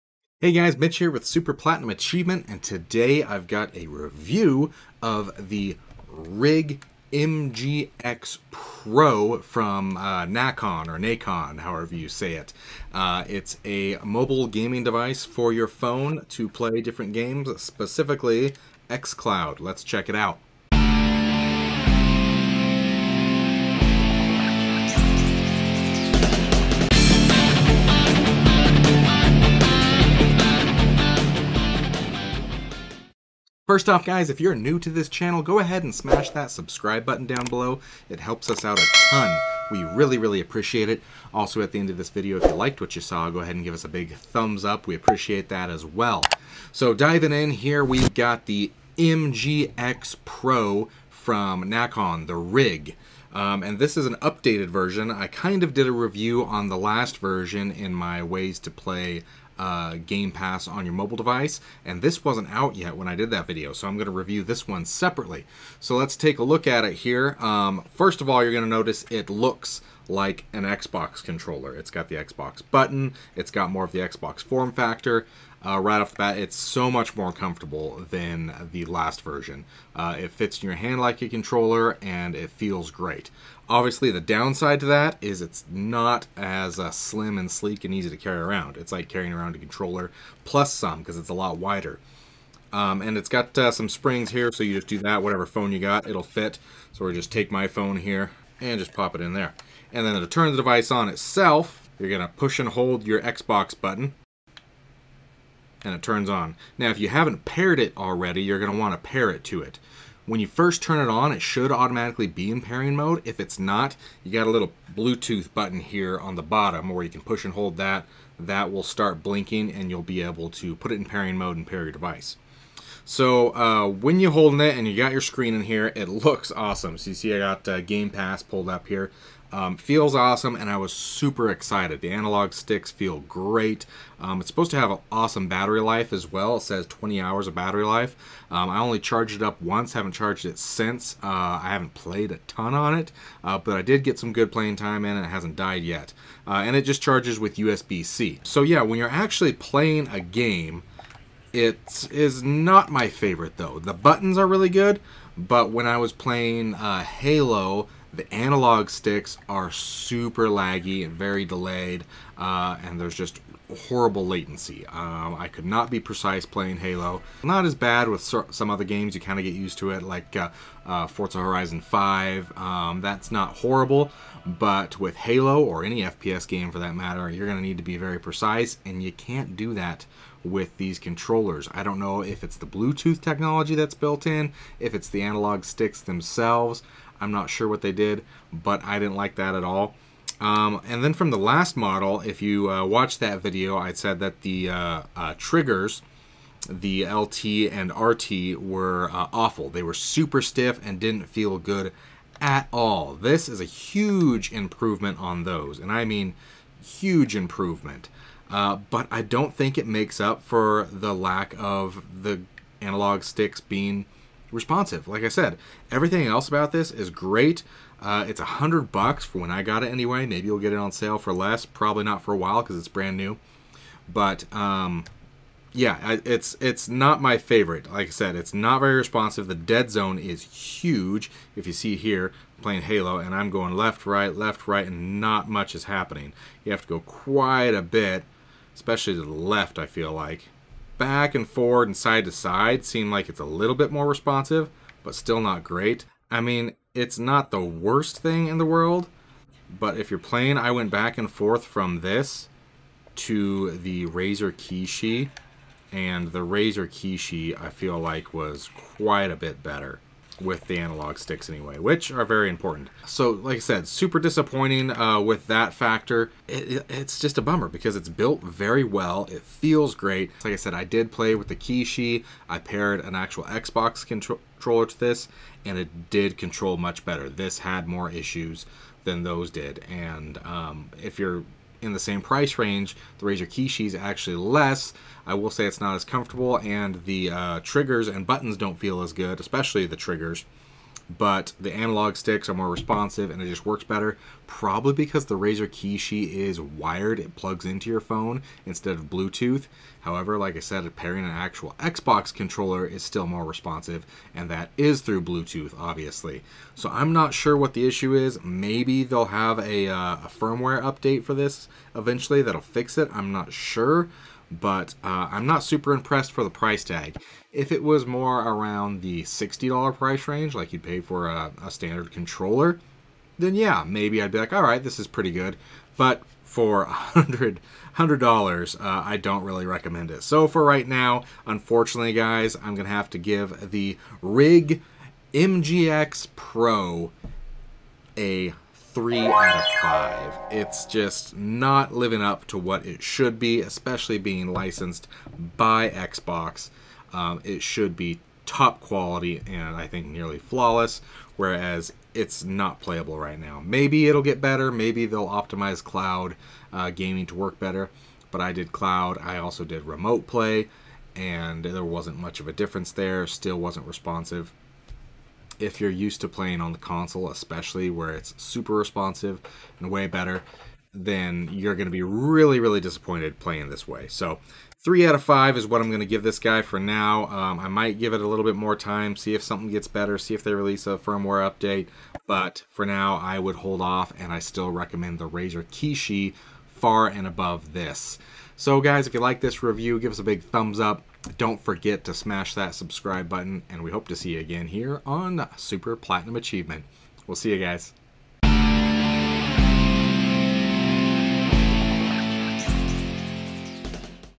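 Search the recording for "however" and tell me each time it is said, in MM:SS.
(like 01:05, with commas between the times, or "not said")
00:11, 05:00.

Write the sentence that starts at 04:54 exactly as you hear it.
Probably because the Razer Kishi is wired, it plugs into your phone instead of Bluetooth.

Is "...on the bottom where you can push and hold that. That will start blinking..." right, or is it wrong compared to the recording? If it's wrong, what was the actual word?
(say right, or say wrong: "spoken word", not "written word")
right.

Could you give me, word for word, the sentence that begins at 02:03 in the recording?
So uh, when you're holding it and you got your screen in here, it looks awesome.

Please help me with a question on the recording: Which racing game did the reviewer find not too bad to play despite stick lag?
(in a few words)
Forza Horizon 5.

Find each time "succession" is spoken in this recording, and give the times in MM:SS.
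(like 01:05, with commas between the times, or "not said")
not said.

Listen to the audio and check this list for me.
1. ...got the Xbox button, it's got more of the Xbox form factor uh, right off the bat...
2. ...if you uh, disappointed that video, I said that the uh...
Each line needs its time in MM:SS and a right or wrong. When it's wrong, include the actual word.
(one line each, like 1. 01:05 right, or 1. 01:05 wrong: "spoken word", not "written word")
1. 01:11 right
2. 03:12 wrong: "watched", not "disappointed".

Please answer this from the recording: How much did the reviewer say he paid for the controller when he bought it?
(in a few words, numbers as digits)
$100.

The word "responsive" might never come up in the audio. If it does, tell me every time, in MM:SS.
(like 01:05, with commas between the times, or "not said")
03:34, 03:48, 04:04, 04:52, 05:03, 06:03, 06:08.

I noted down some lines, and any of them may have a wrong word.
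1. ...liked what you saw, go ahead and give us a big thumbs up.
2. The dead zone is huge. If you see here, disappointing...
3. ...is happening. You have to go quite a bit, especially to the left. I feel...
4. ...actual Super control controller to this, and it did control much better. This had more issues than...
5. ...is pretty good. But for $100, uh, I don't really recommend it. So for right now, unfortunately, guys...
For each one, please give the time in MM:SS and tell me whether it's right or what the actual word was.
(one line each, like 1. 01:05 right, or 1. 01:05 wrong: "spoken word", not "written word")
1. 00:42 right
2. 03:49 wrong: "playing", not "disappointing"
3. 03:55 right
4. 04:33 wrong: "Xbox", not "Super"
5. 05:24 right.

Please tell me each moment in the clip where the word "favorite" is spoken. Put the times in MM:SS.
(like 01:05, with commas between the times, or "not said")
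02:33, 03:47.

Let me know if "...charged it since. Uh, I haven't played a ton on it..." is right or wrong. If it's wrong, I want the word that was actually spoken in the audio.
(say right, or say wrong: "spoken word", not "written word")
right.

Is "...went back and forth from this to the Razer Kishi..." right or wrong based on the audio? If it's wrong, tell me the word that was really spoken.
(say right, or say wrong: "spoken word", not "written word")
right.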